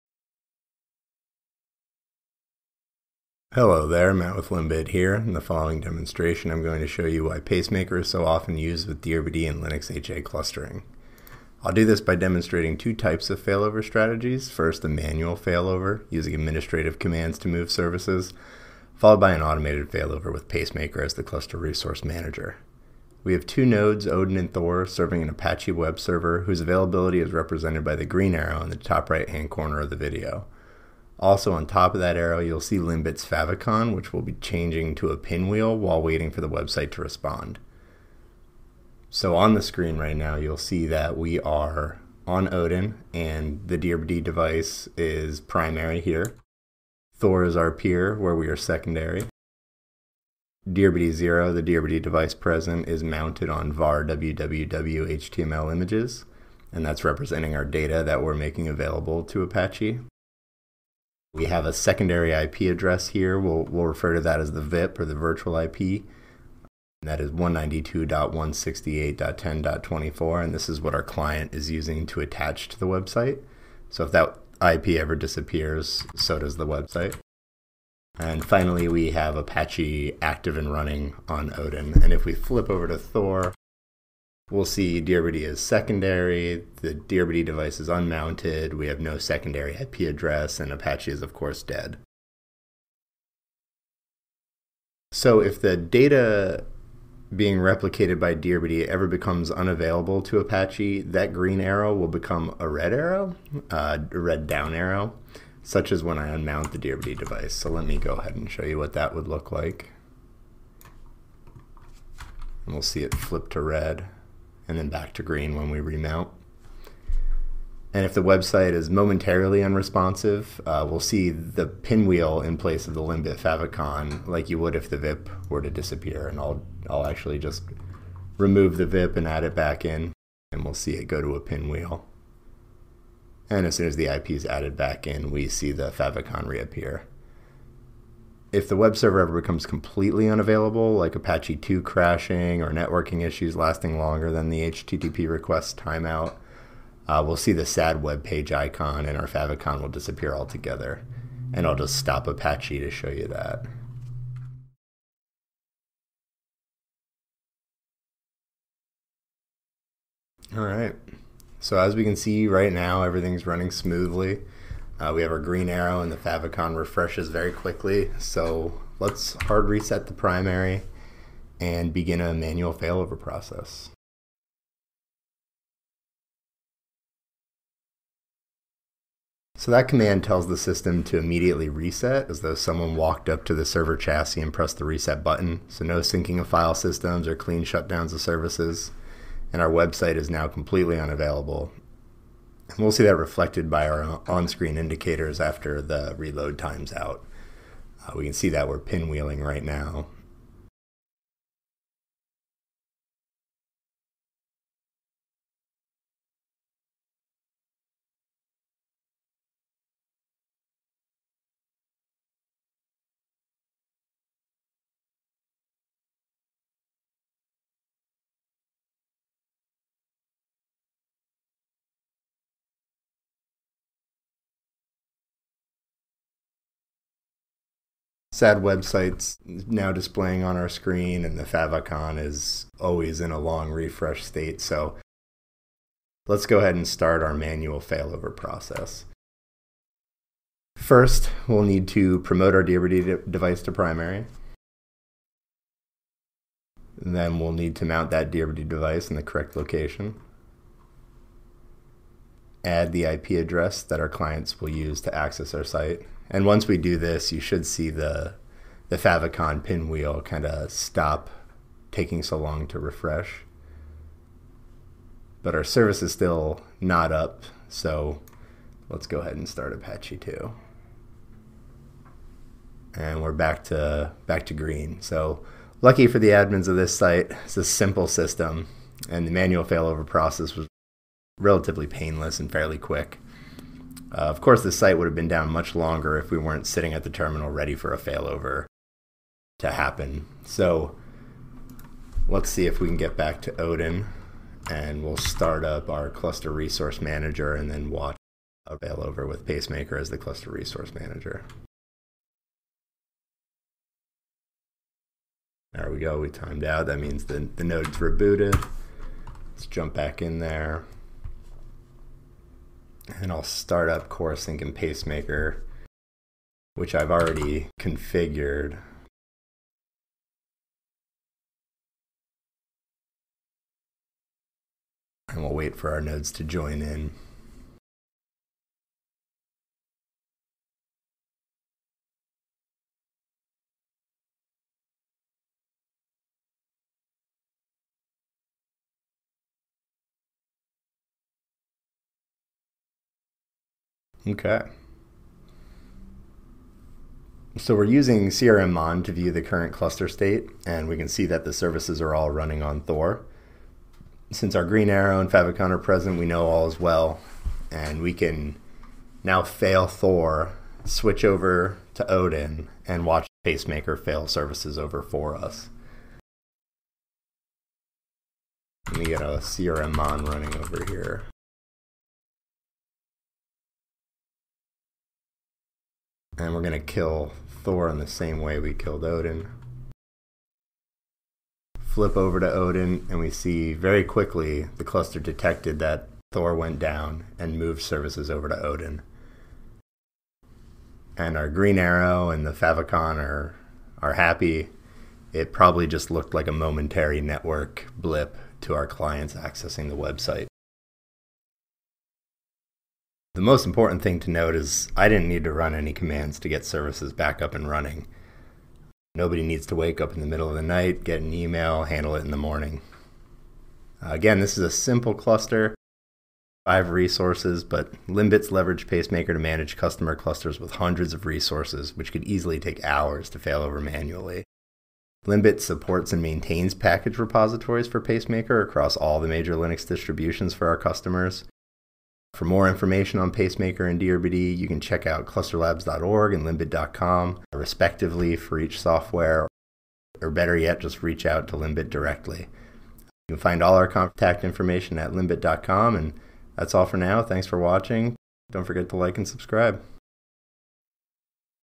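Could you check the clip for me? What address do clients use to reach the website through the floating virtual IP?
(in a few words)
192.168.10.24.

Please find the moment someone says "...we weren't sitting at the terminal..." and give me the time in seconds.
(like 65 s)
286 s.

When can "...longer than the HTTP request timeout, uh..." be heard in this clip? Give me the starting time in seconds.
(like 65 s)
143 s.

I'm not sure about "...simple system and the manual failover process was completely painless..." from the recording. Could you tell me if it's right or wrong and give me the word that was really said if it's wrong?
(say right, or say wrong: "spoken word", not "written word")
wrong: "relatively", not "completely".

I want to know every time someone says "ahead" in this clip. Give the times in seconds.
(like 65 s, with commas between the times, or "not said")
108 s, 236 s, 269 s.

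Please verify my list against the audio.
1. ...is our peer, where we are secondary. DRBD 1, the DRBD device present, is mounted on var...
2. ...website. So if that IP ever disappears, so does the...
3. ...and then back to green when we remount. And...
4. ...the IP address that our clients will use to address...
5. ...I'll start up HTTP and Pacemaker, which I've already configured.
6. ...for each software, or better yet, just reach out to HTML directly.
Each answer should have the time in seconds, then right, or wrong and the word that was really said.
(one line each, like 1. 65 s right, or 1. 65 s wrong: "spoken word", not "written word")
1. 47 s wrong: "0", not "1"
2. 72 s right
3. 114 s right
4. 252 s wrong: "access", not "address"
5. 313 s wrong: "Corosync", not "HTTP"
6. 438 s wrong: "LINBIT", not "HTML".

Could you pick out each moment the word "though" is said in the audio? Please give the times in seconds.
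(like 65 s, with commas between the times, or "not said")
182 s.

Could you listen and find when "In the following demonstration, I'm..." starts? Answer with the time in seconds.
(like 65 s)
5 s.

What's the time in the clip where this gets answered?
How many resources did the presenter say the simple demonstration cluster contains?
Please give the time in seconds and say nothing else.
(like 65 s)
416 s.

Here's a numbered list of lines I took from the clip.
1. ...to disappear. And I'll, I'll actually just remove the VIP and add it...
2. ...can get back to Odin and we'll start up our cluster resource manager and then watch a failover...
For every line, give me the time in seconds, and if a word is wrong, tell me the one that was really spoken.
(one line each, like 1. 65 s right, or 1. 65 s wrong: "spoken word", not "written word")
1. 125 s right
2. 292 s right.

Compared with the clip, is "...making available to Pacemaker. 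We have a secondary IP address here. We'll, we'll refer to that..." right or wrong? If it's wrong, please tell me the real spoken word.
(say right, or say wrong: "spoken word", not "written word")
wrong: "Apache", not "Pacemaker".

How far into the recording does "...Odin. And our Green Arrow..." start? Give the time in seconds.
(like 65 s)
388 s.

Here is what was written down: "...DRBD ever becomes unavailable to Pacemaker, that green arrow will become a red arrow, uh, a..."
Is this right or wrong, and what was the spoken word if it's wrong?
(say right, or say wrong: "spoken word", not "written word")
wrong: "Apache", not "Pacemaker".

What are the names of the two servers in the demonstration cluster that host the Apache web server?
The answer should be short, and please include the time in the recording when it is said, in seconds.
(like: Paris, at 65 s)
Odin and Thor, at 24 s.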